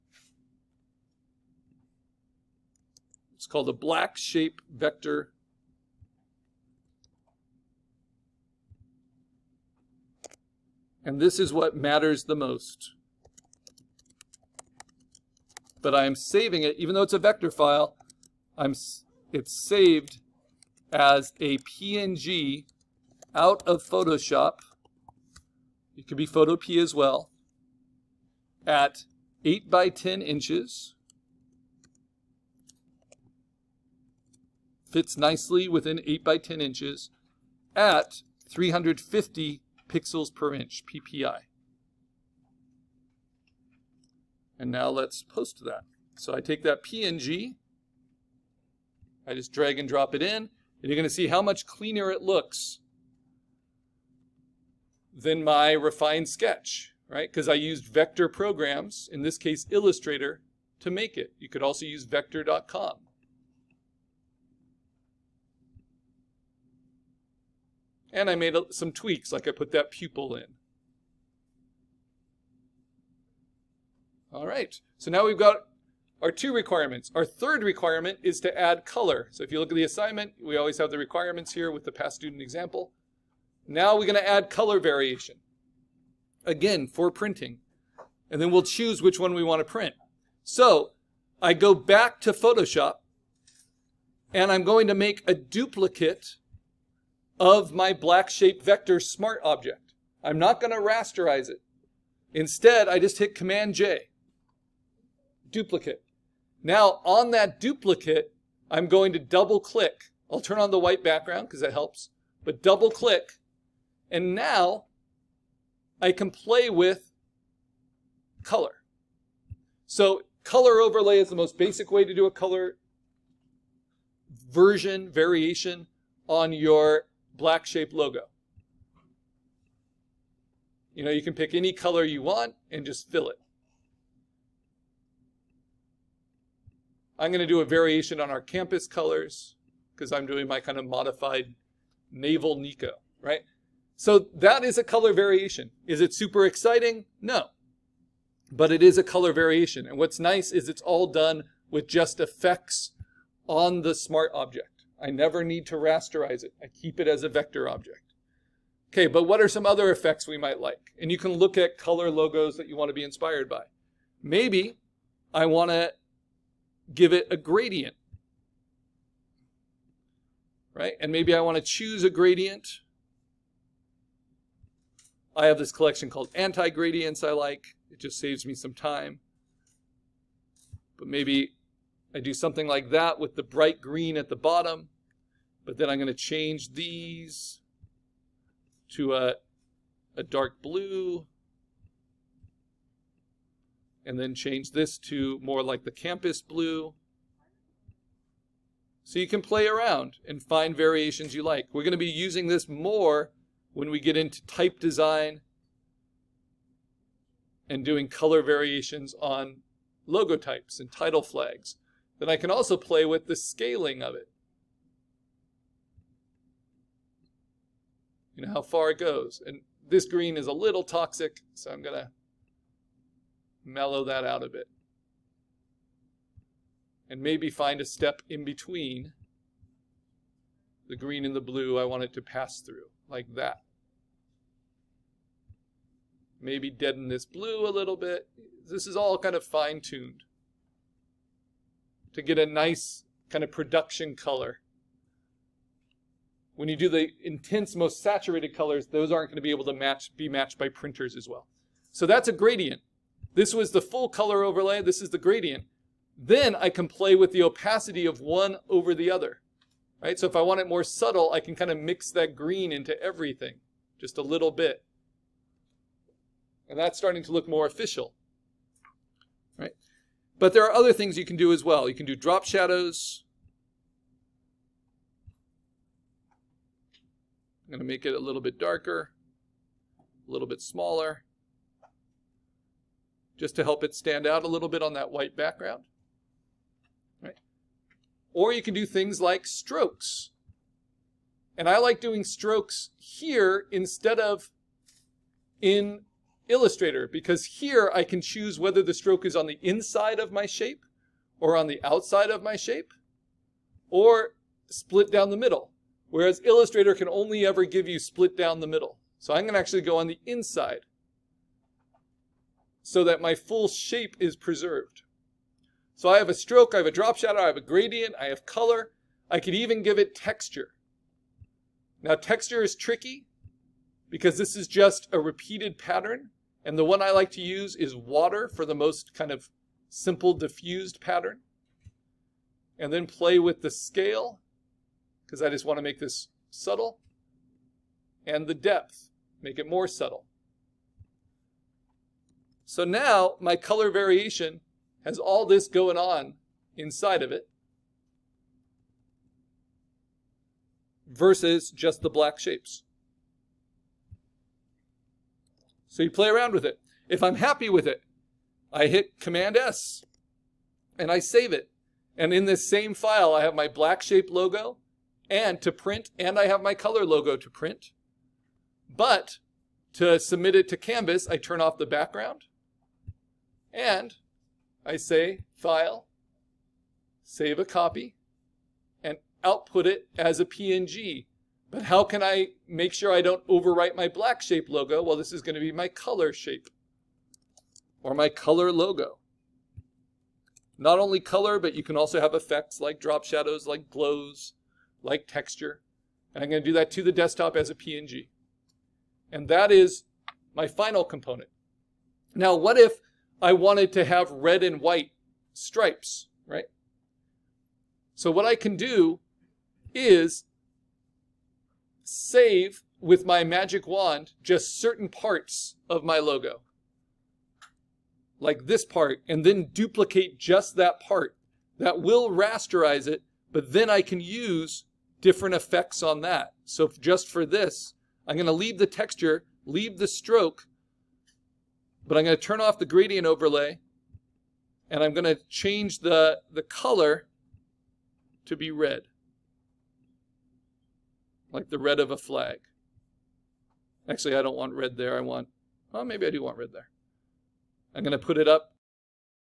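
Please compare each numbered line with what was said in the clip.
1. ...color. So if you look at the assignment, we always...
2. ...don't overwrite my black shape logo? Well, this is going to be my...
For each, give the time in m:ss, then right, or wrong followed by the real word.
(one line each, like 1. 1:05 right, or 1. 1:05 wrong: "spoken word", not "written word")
1. 1:18 right
2. 6:23 right.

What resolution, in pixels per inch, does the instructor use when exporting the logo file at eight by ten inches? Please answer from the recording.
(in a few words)
350.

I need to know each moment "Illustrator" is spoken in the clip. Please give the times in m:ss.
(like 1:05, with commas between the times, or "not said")
0:59, 4:56, 5:06.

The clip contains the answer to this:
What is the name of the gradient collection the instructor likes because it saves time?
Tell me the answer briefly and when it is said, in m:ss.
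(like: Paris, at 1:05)
anti-gradients, at 2:56.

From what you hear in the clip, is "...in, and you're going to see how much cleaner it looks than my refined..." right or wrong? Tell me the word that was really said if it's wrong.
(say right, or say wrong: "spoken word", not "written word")
right.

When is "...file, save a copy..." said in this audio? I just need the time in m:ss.
6:15.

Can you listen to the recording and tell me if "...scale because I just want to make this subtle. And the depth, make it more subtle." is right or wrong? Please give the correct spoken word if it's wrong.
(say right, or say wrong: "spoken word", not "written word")
right.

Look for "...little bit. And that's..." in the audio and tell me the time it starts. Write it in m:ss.
4:24.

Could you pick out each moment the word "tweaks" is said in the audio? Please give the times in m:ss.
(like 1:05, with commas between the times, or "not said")
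1:08.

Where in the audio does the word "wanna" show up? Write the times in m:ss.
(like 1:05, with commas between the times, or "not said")
1:29.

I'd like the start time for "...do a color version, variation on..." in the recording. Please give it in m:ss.
2:02.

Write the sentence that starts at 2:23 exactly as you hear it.
So that is a color variation.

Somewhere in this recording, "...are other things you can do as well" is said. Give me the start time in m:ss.
4:30.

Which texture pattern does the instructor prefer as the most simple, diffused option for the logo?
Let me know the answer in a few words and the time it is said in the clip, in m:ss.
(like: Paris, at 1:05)
Water, at 5:27.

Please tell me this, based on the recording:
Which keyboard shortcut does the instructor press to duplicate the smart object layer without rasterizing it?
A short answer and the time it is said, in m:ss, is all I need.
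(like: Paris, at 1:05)
Command J, at 1:43.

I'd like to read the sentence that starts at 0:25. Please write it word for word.
It could be Photopea as well.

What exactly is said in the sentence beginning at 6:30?
Not only color, but you can also have effects like drop shadows, like glows, like texture.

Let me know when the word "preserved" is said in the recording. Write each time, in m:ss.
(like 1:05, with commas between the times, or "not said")
5:14.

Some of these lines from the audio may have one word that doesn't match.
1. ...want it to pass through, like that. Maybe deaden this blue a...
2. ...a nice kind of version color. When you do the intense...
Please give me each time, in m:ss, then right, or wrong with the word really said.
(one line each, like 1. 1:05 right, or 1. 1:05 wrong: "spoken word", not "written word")
1. 3:51 right
2. 4:02 wrong: "production", not "version".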